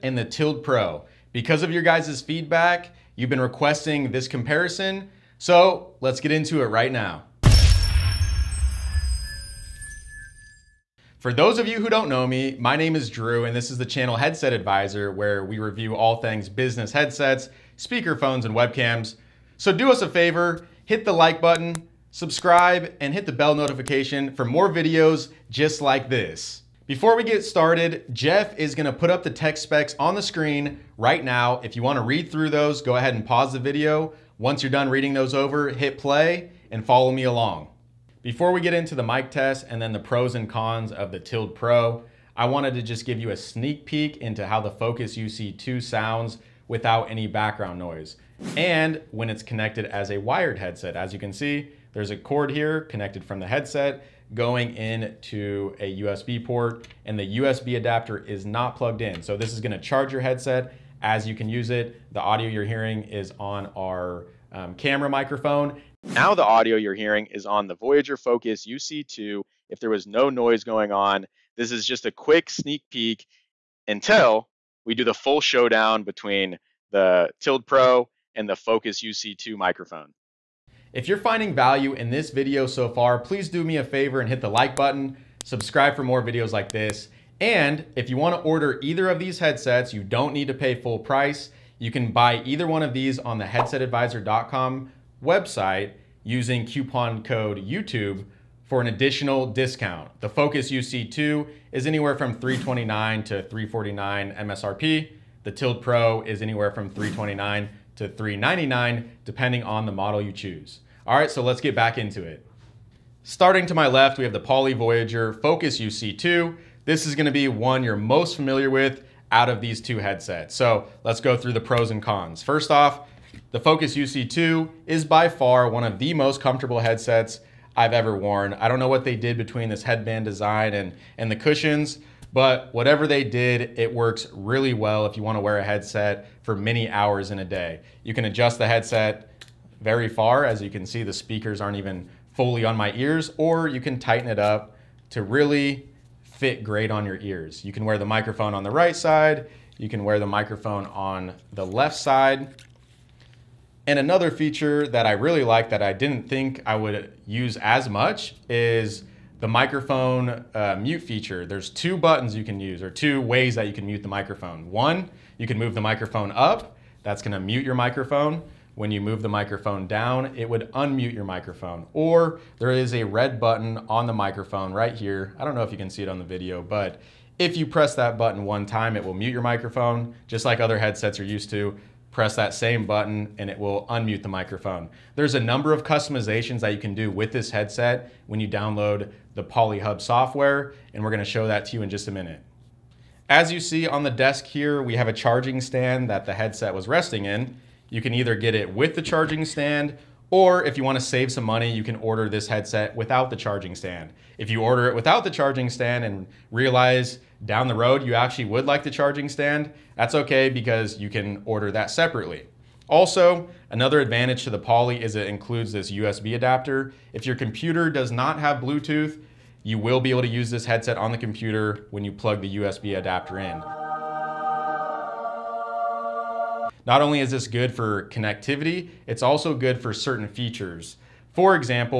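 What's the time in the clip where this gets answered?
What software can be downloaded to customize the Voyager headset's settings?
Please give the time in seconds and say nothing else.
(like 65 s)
189 s.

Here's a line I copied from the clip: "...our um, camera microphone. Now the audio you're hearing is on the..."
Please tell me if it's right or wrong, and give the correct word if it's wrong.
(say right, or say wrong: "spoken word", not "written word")
right.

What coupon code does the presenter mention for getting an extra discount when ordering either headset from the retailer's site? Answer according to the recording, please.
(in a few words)
YouTube.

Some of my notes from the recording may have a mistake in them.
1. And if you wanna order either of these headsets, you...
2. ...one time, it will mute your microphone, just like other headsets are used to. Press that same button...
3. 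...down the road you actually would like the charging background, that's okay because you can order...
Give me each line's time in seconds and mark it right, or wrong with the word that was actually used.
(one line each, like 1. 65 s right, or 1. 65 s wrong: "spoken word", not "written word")
1. 87 s right
2. 178 s right
3. 207 s wrong: "stand", not "background".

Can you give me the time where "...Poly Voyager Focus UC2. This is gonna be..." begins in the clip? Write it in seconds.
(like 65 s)
114 s.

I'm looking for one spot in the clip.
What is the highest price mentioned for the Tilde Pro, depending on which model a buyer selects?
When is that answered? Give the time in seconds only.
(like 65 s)
108 s.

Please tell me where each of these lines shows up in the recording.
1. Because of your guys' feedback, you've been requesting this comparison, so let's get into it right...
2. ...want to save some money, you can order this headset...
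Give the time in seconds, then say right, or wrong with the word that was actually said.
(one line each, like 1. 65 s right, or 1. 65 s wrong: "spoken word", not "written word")
1. 1 s right
2. 200 s right.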